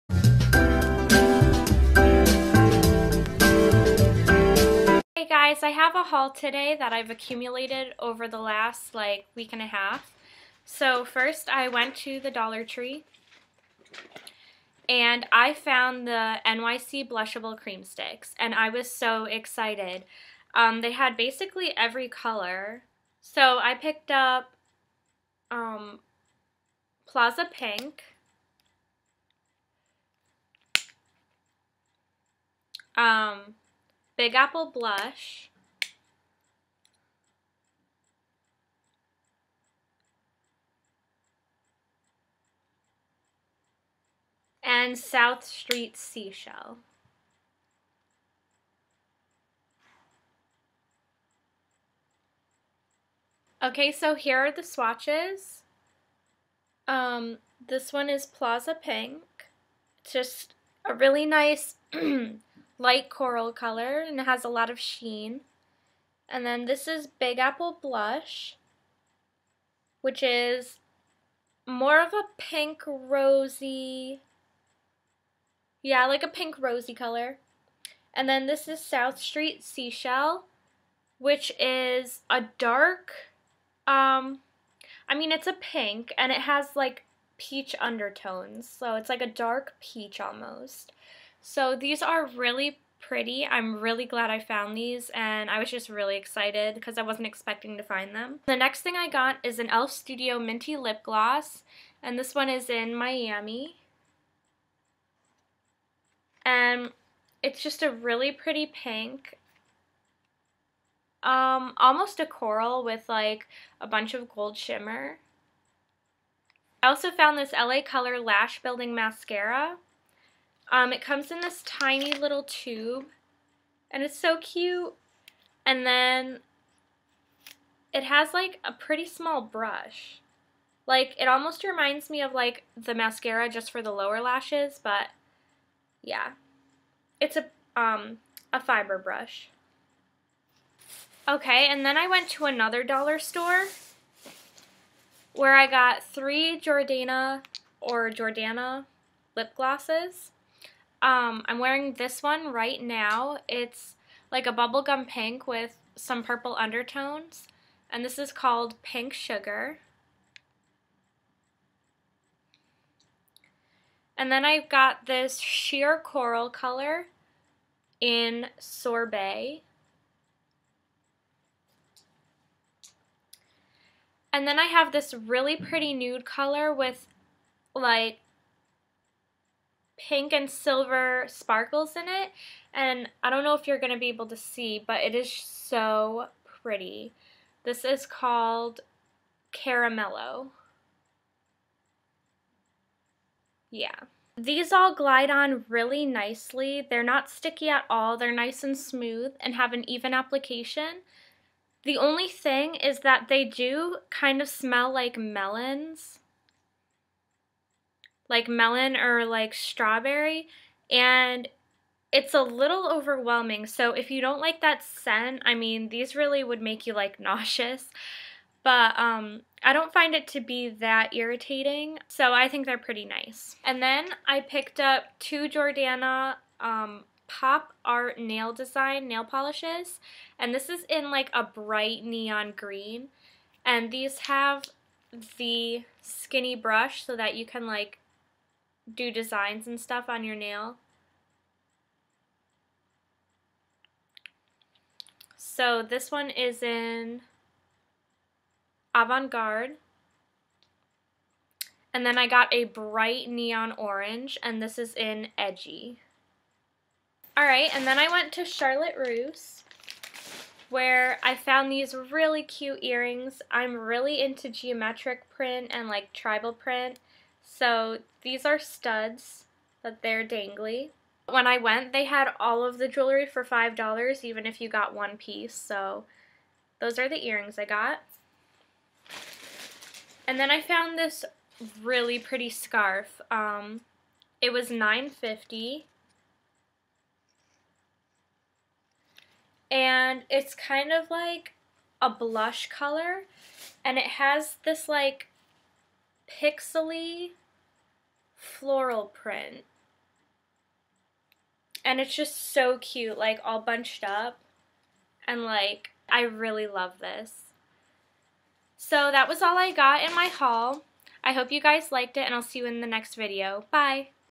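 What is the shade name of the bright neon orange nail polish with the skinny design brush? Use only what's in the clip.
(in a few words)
Edgy.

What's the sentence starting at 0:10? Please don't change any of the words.
So first I went to the Dollar Tree and I found the NYC Blushable Cream Sticks and I was so excited.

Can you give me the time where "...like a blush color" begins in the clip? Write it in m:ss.
4:51.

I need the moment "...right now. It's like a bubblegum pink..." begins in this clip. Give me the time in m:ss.
2:32.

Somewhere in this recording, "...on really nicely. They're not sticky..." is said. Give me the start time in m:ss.
3:15.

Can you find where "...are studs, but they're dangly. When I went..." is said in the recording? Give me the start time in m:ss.
4:28.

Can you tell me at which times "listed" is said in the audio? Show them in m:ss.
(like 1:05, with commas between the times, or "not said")
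not said.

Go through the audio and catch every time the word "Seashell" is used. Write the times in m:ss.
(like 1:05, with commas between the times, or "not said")
0:45, 1:19.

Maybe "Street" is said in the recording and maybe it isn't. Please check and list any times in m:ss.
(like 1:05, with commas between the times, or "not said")
0:45, 1:19.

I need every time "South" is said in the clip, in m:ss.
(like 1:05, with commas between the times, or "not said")
0:44, 1:18.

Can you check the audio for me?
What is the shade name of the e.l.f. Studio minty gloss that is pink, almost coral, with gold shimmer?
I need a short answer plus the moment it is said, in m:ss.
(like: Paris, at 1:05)
Miami, at 1:42.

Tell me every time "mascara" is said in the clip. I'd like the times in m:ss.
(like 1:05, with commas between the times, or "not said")
1:58, 2:12.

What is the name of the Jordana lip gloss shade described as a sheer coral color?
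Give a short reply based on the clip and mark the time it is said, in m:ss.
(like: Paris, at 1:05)
Sorbet, at 2:48.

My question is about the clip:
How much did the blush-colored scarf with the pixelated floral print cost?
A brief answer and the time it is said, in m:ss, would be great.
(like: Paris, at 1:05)
$9.50, at 4:44.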